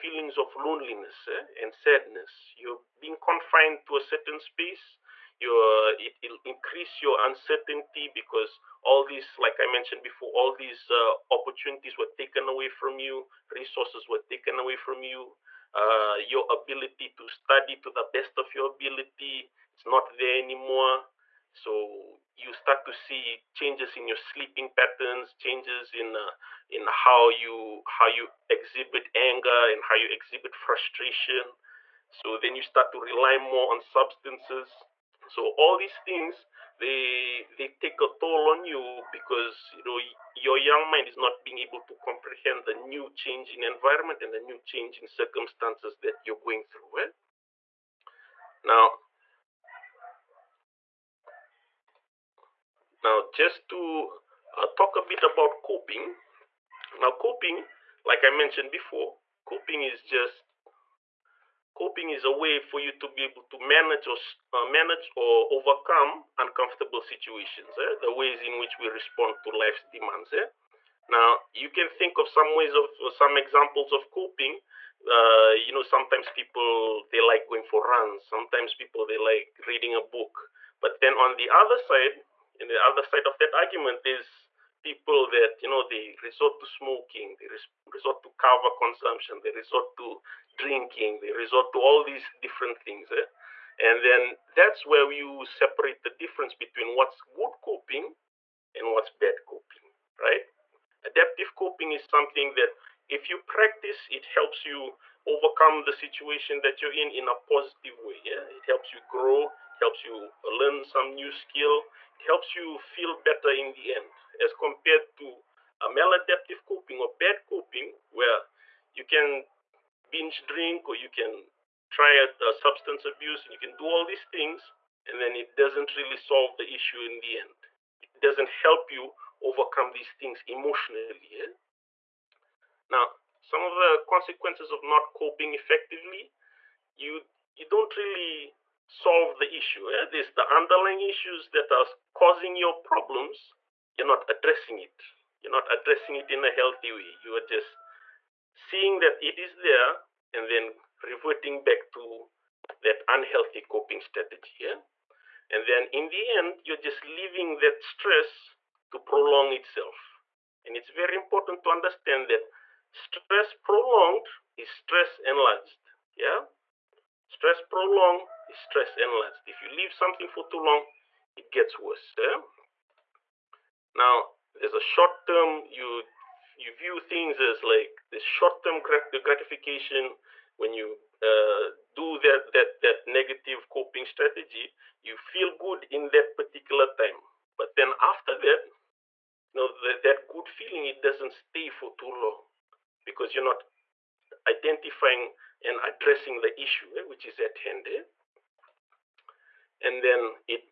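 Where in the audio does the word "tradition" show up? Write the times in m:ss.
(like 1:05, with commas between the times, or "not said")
not said.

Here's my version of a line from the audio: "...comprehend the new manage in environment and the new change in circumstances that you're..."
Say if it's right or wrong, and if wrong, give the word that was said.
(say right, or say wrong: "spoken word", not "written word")
wrong: "change", not "manage".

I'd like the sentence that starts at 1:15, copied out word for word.
Uh, you know, sometimes people they like going for runs.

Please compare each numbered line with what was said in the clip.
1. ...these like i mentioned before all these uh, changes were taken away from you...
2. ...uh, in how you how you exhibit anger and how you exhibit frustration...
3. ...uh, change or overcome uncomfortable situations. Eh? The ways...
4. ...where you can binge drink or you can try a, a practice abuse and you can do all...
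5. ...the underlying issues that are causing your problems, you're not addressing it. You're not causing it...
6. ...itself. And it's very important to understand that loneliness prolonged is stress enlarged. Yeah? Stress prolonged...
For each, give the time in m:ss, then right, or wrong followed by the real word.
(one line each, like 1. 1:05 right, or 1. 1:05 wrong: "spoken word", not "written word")
1. 0:09 wrong: "opportunities", not "changes"
2. 0:26 right
3. 1:04 wrong: "manage", not "change"
4. 1:58 wrong: "substance", not "practice"
5. 2:20 wrong: "addressing", not "causing"
6. 2:39 wrong: "stress", not "loneliness".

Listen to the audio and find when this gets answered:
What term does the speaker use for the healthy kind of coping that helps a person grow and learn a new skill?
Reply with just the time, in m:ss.
1:41.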